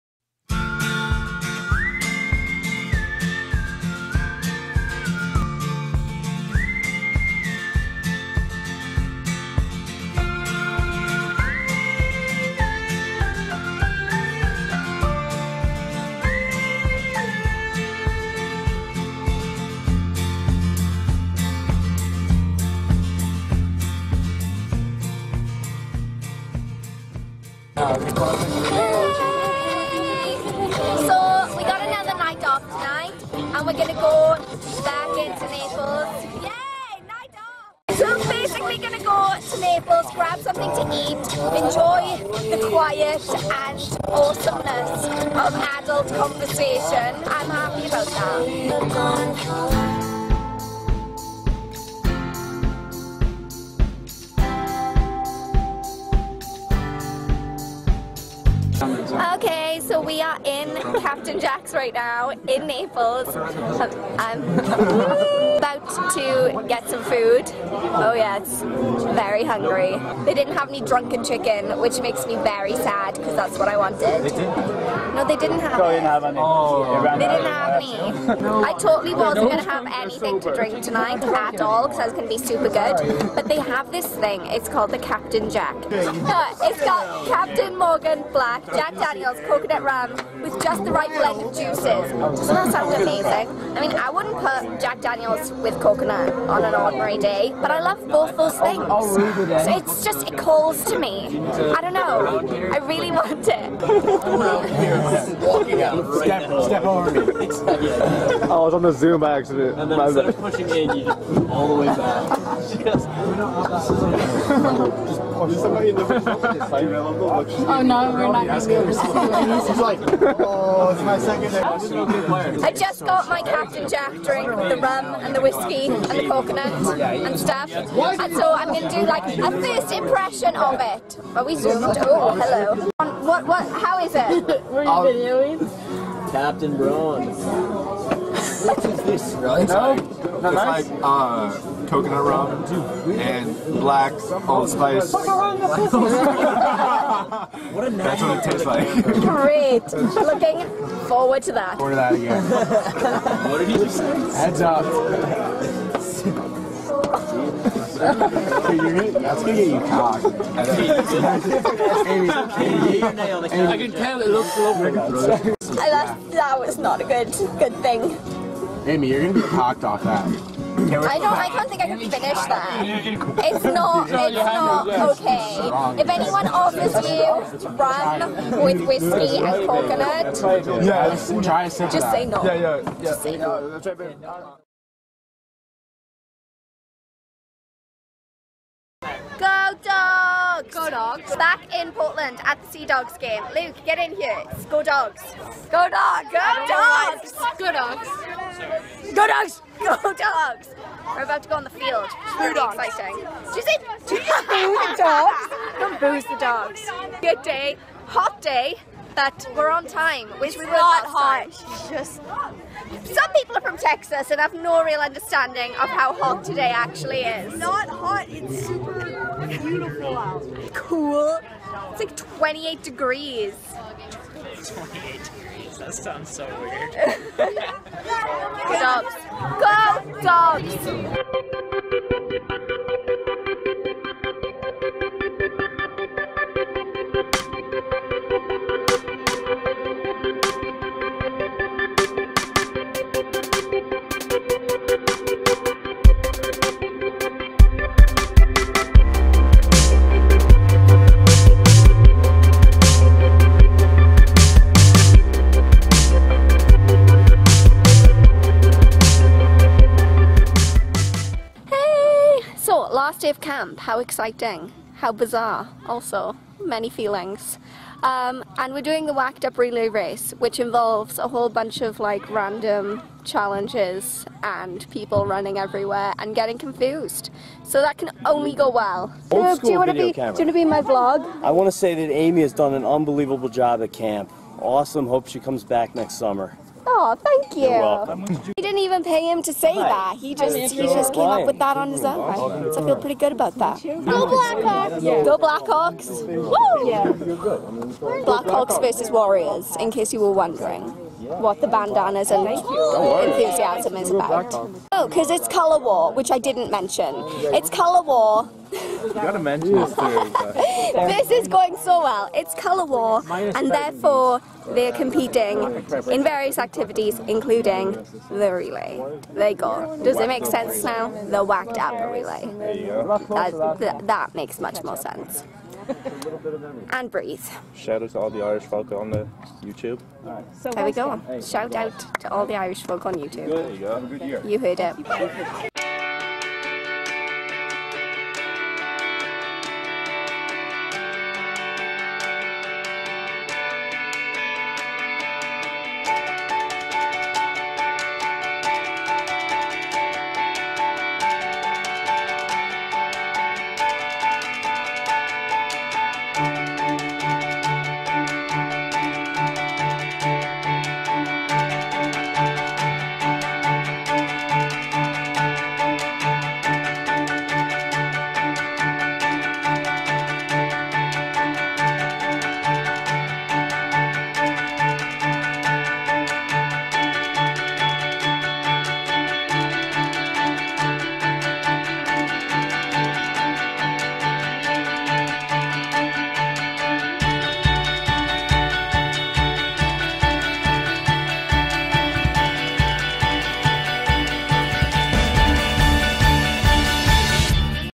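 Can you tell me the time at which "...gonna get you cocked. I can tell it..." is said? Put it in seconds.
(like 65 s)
159 s.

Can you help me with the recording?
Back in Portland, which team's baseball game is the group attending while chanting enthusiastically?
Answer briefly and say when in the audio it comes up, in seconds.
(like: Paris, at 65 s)
Sea Dogs, at 192 s.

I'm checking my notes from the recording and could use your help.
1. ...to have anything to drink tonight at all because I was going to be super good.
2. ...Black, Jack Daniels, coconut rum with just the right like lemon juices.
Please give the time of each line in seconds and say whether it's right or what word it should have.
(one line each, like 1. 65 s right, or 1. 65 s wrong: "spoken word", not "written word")
1. 79 s right
2. 88 s right.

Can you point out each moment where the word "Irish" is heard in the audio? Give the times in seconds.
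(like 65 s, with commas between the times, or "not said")
328 s, 332 s.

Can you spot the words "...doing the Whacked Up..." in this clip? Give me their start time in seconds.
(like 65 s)
268 s.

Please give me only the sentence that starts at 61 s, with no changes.
Captain Jack's right now in Naples.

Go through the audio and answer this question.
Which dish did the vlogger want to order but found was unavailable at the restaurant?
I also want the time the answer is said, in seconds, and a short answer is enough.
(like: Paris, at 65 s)
drunken chicken, at 70 s.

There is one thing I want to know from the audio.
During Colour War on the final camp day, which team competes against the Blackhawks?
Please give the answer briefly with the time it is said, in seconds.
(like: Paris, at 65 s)
Warriors, at 299 s.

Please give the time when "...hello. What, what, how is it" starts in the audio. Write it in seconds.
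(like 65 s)
132 s.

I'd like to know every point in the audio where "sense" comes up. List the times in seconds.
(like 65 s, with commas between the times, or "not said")
320 s, 324 s.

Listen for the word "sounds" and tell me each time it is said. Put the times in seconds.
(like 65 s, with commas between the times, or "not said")
92 s, 225 s.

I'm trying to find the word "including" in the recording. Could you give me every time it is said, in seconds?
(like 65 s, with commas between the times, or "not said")
317 s.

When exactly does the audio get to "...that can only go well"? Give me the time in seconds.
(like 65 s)
277 s.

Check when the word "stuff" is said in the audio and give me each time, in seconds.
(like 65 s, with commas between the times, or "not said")
127 s.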